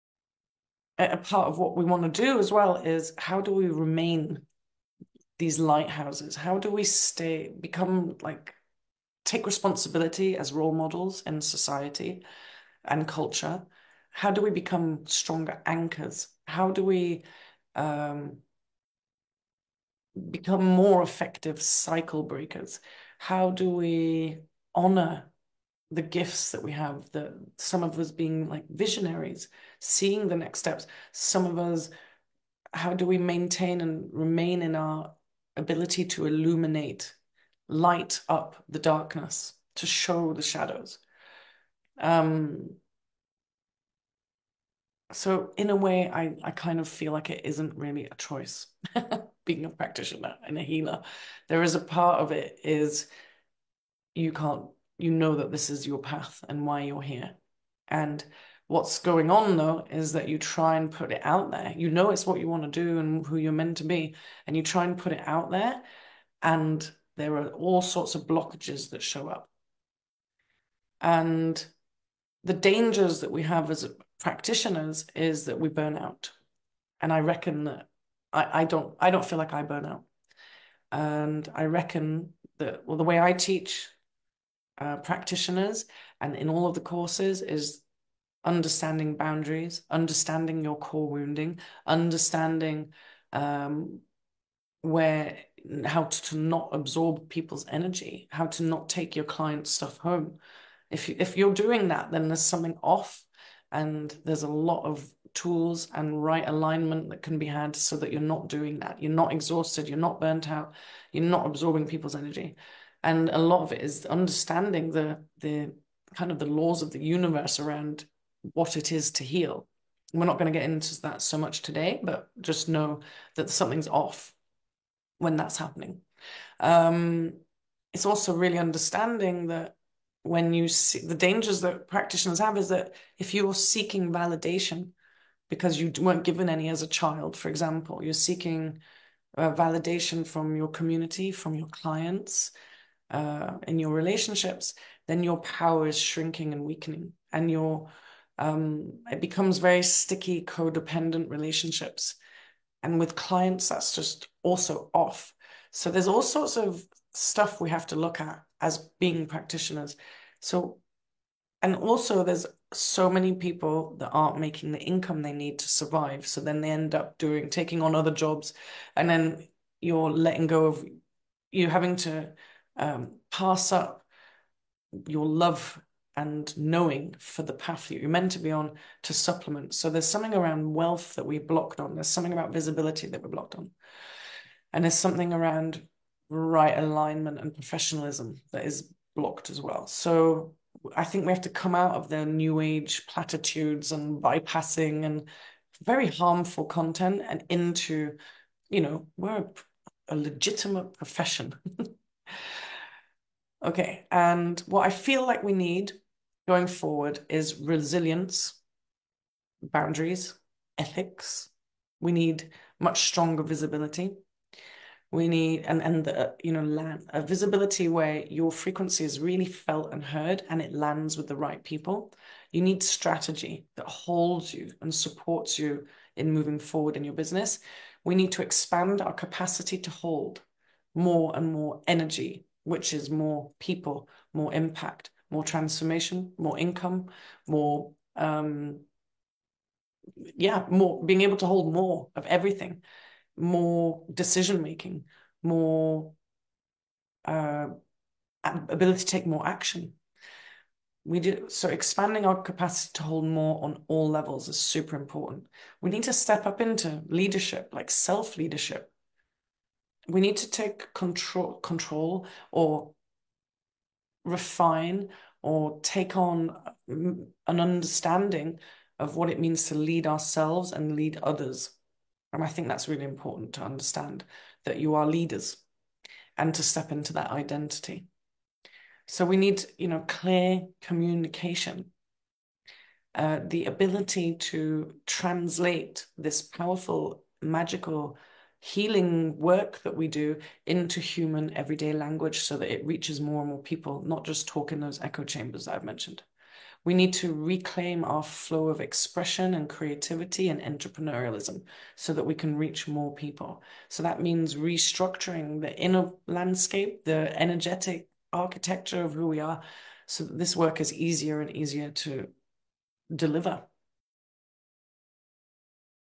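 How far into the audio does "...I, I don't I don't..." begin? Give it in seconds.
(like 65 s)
78 s.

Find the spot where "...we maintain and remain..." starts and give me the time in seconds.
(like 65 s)
33 s.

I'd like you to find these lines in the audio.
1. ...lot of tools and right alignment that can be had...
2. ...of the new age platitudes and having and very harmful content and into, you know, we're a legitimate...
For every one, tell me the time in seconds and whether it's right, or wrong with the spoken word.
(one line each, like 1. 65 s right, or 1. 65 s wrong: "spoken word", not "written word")
1. 104 s right
2. 191 s wrong: "bypassing", not "having".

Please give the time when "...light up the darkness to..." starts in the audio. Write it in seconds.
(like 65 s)
37 s.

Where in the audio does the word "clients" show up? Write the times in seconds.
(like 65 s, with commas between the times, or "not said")
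99 s, 141 s, 153 s.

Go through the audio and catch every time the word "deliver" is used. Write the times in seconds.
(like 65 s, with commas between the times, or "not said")
313 s.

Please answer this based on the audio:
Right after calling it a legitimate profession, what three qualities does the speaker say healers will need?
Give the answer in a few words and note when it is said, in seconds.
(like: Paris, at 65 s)
resilience, boundaries, ethics, at 207 s.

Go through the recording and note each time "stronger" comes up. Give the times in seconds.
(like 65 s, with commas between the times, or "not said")
15 s, 213 s.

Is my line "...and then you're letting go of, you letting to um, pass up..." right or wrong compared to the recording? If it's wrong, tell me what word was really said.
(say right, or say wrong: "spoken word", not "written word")
wrong: "having", not "letting".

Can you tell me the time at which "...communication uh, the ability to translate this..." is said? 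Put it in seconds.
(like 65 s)
280 s.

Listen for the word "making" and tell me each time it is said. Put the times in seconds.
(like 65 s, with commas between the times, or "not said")
164 s, 244 s.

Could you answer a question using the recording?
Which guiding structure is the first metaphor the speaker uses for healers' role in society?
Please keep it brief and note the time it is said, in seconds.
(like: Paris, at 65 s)
lighthouses, at 5 s.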